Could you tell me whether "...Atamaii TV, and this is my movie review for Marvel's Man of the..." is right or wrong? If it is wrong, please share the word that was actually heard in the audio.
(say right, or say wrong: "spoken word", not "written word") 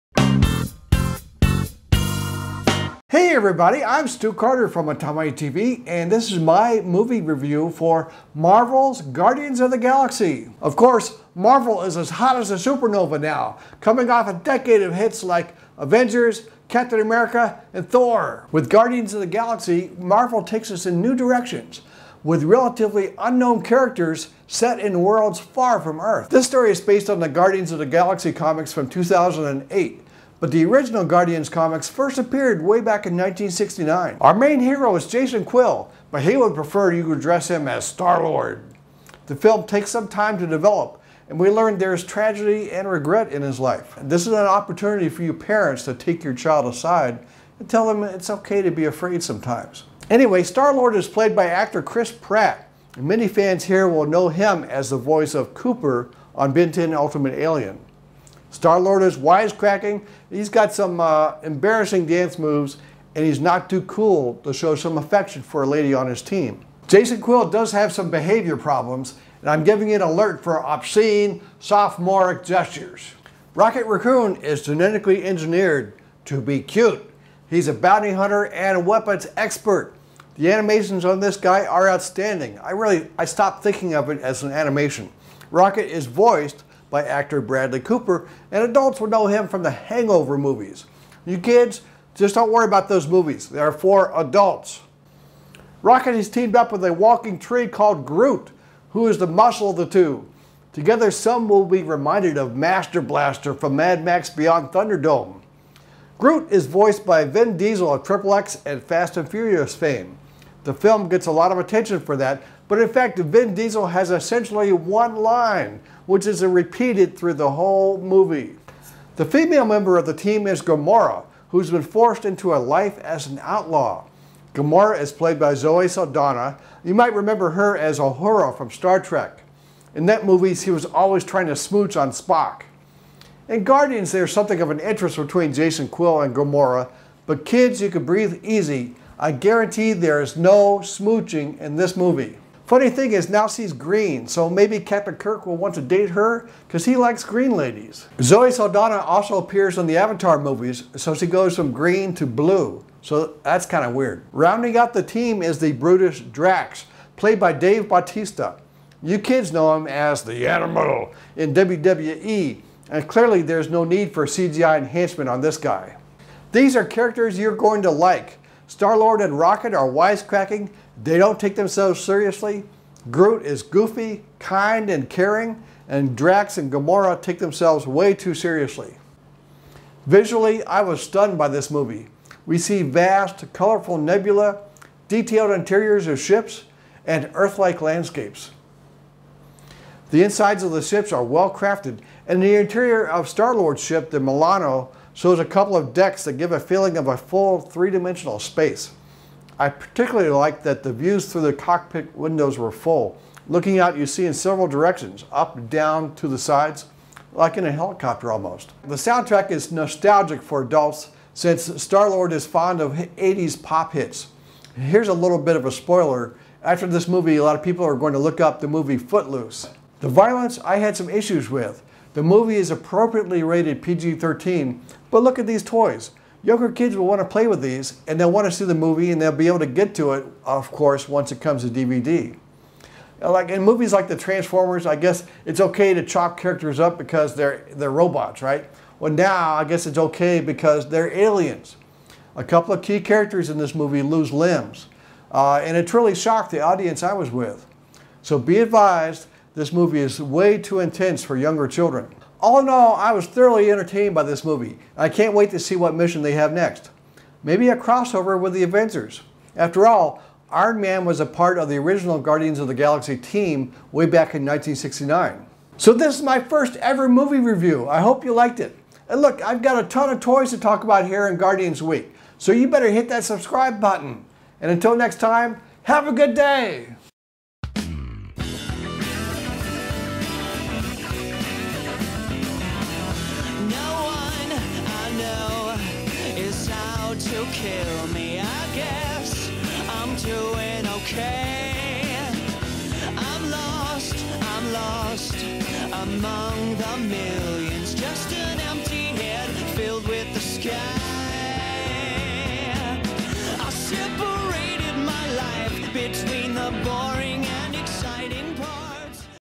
wrong: "Guardians", not "Man".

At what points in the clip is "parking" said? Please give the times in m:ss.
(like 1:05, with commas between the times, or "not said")
not said.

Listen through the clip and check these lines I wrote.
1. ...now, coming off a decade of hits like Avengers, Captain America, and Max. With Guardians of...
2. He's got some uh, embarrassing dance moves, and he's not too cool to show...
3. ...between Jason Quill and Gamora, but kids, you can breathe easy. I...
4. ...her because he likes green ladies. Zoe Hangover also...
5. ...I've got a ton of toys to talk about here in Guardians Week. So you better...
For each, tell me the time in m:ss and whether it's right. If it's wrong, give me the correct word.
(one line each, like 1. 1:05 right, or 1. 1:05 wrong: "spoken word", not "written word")
1. 0:13 wrong: "Thor", not "Max"
2. 1:00 right
3. 2:15 right
4. 2:26 wrong: "Saldana", not "Hangover"
5. 4:29 right.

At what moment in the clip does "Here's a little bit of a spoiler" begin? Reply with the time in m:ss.
3:34.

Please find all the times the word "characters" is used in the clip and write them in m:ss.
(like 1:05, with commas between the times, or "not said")
0:23, 2:46, 3:56, 4:03.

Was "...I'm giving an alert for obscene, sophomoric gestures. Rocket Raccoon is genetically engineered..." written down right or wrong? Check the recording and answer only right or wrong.
right.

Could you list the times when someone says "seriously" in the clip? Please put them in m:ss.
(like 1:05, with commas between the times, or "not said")
2:52, 2:58.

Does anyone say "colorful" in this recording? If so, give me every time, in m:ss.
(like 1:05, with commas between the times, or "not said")
3:03.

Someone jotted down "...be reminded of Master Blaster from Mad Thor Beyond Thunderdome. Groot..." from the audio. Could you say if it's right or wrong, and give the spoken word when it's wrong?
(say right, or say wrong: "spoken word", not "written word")
wrong: "Max", not "Thor".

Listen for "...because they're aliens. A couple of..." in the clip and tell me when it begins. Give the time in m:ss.
4:00.